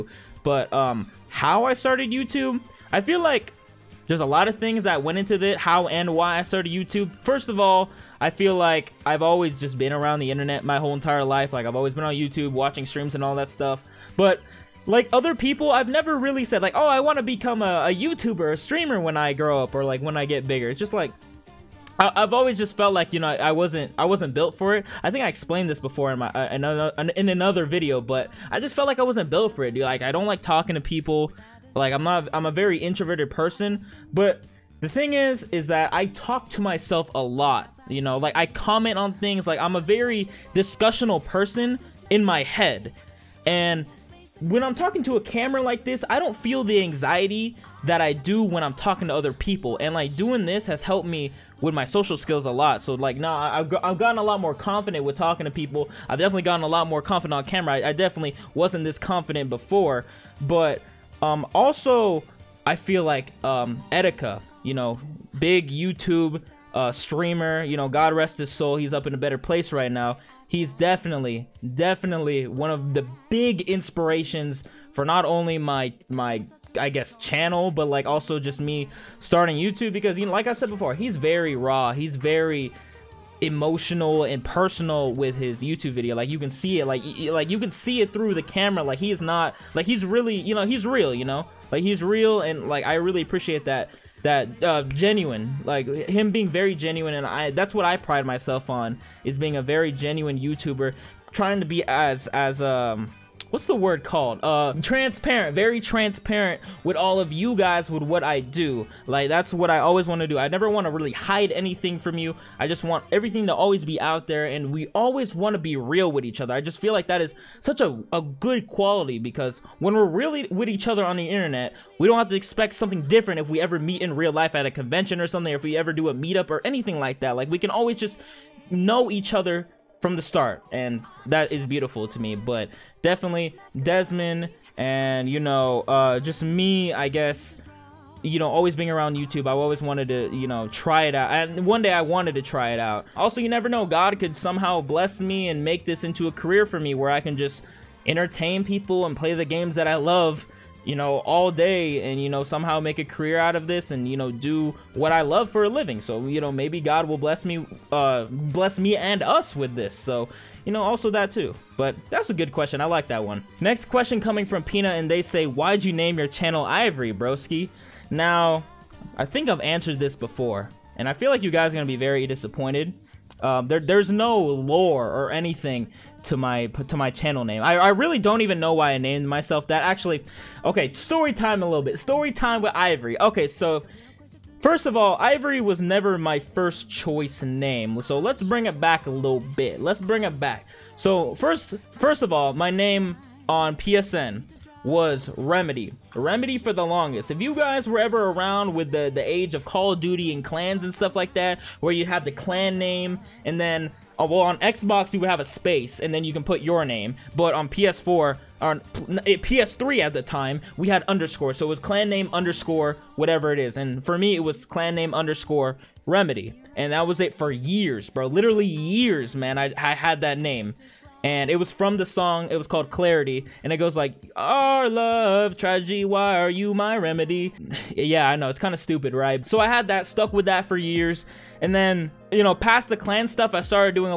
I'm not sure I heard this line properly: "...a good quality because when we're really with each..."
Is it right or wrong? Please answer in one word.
right.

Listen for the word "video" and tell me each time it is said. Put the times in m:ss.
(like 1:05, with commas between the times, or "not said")
0:27, 1:25.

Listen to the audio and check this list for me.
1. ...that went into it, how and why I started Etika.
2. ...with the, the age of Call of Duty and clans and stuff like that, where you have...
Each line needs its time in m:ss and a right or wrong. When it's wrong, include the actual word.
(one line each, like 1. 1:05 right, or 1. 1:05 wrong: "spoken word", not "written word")
1. 0:04 wrong: "YouTube", not "Etika"
2. 3:18 right.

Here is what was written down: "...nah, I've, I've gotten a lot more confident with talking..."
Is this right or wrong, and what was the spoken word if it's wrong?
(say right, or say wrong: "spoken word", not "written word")
right.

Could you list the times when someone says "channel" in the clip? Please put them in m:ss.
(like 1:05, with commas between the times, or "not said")
1:17, 2:46, 2:57.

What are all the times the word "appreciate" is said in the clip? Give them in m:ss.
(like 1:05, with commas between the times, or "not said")
1:33.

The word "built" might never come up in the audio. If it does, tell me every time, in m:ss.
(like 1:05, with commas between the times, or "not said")
0:24, 0:29.